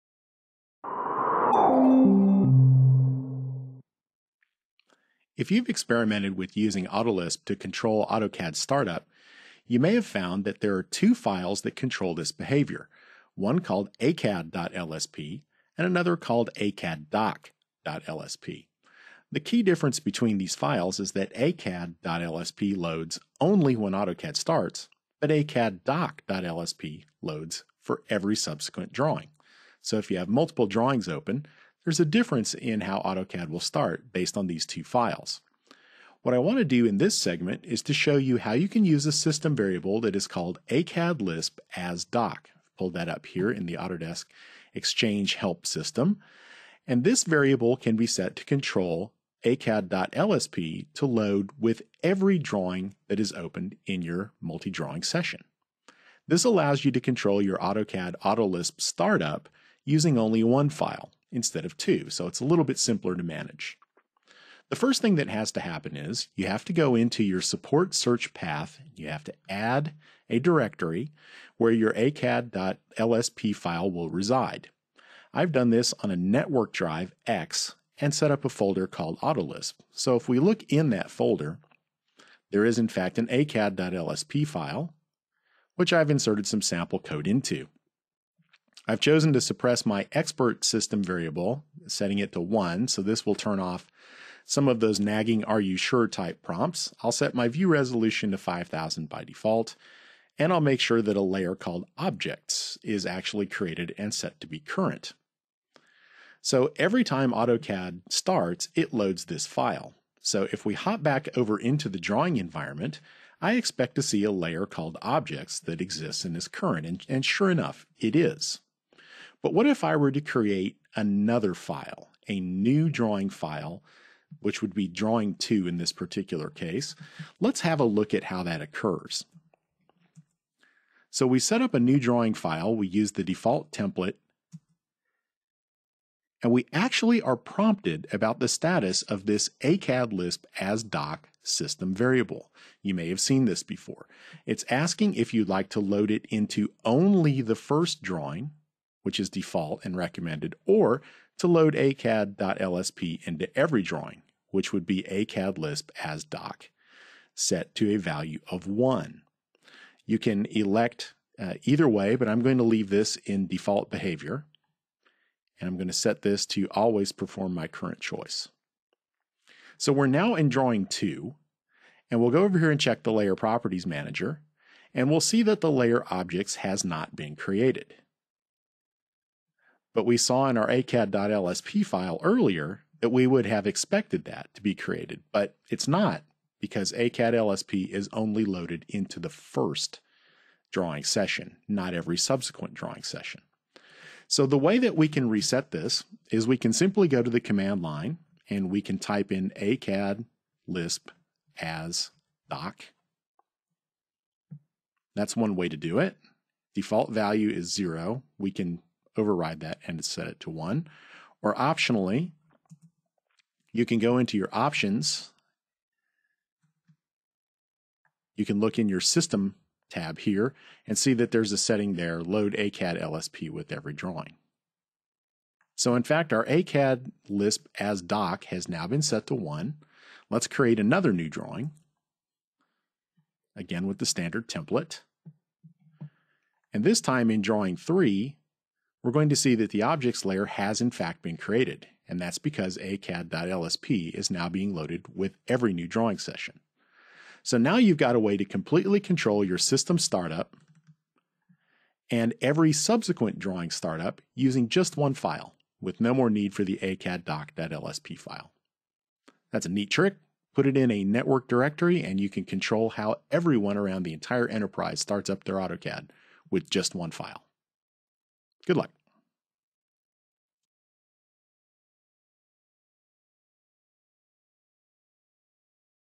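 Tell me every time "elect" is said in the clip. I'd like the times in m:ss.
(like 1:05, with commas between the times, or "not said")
2:40.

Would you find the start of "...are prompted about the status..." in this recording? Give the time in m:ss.
2:17.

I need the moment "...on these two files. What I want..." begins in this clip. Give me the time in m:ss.
0:34.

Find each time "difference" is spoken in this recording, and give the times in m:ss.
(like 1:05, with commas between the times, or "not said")
0:19, 0:32.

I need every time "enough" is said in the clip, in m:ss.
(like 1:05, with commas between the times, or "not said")
1:57.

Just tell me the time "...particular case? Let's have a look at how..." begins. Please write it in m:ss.
2:05.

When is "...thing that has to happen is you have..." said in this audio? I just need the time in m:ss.
1:05.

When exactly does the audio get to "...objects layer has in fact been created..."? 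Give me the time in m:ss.
3:59.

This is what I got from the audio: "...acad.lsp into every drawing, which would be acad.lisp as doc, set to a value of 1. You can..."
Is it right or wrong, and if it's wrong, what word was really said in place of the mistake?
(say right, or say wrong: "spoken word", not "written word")
right.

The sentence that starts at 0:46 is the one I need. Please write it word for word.
And this variable can be set to control acad.lsp to load with every drawing that is opened in your multi-drawing session.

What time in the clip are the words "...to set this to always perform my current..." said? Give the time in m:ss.
2:45.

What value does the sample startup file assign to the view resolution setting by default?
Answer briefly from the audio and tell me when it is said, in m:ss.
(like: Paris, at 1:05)
5000, at 1:38.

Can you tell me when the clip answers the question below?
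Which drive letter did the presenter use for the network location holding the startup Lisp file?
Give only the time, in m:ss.
1:17.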